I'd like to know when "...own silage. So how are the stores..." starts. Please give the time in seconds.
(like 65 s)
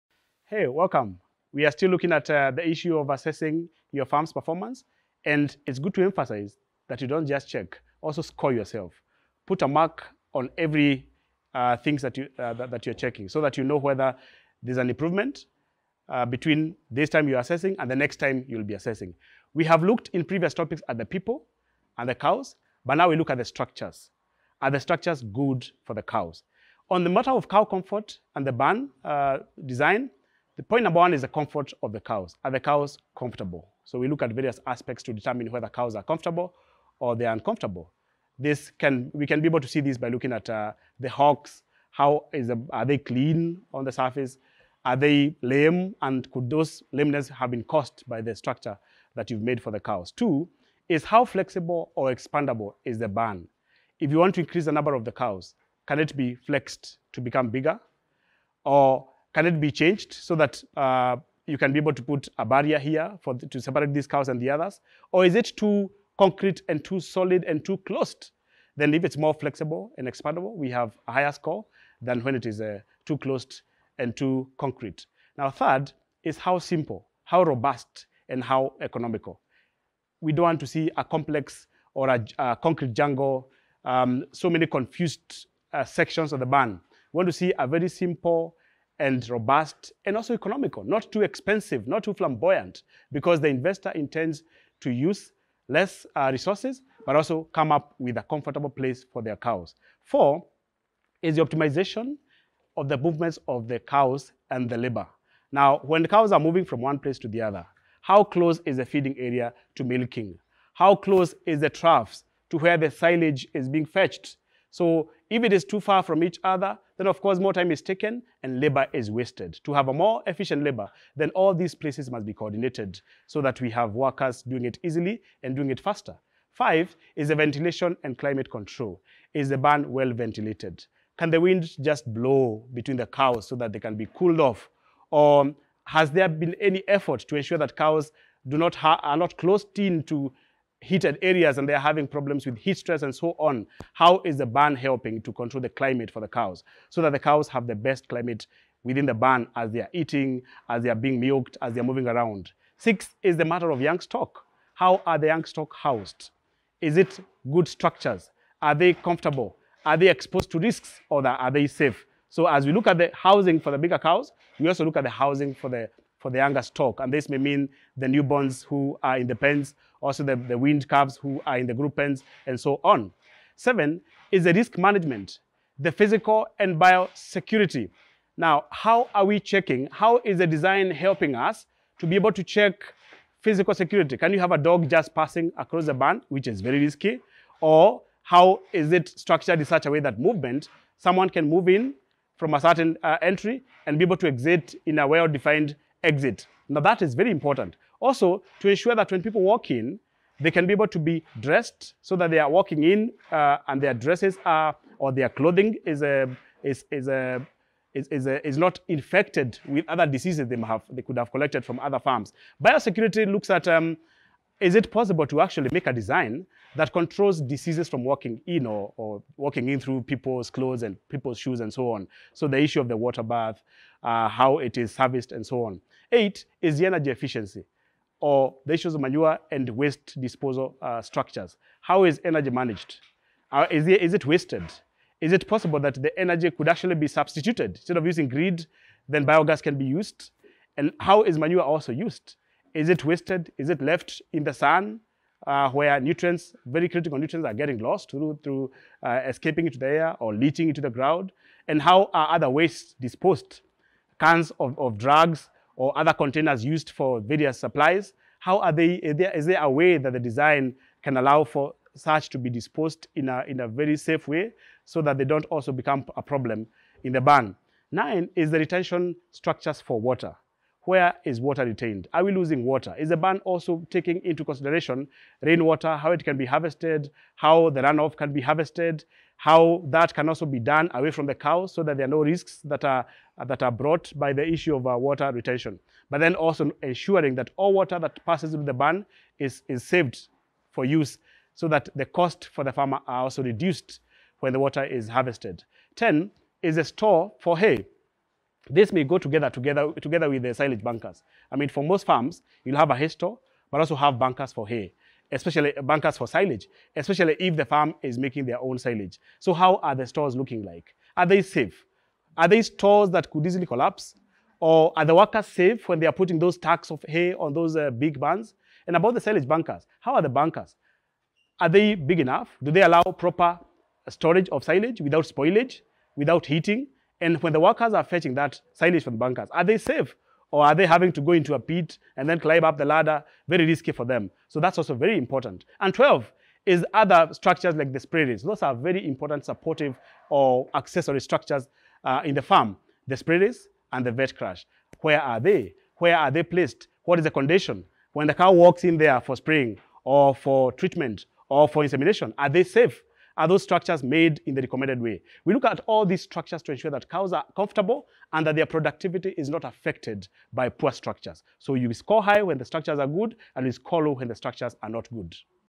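308 s.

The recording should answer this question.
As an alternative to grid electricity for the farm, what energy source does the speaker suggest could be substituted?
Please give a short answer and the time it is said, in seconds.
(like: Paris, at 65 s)
biogas, at 239 s.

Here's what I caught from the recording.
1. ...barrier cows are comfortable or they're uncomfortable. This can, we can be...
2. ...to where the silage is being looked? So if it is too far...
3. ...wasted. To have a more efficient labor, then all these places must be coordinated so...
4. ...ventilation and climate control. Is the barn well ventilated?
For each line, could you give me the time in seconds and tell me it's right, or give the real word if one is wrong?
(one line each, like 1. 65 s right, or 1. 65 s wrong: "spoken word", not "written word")
1. 35 s wrong: "whether", not "barrier"
2. 112 s wrong: "fetched", not "looked"
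3. 119 s right
4. 127 s right.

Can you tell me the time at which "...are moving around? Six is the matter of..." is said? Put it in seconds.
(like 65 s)
151 s.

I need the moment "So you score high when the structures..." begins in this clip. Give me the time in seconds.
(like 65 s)
361 s.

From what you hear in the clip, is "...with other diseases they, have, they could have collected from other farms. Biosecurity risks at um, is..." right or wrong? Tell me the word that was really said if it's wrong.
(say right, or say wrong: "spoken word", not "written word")
wrong: "looks", not "risks".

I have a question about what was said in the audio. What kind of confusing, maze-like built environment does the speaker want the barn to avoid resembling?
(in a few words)
concrete jungle.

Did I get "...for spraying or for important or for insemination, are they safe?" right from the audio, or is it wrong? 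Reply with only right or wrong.
wrong.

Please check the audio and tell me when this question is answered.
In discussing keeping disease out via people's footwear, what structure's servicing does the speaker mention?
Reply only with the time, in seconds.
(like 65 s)
222 s.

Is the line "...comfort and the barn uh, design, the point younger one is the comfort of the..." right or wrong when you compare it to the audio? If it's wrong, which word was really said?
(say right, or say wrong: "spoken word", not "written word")
wrong: "number", not "younger".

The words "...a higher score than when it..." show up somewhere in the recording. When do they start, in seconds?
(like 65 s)
71 s.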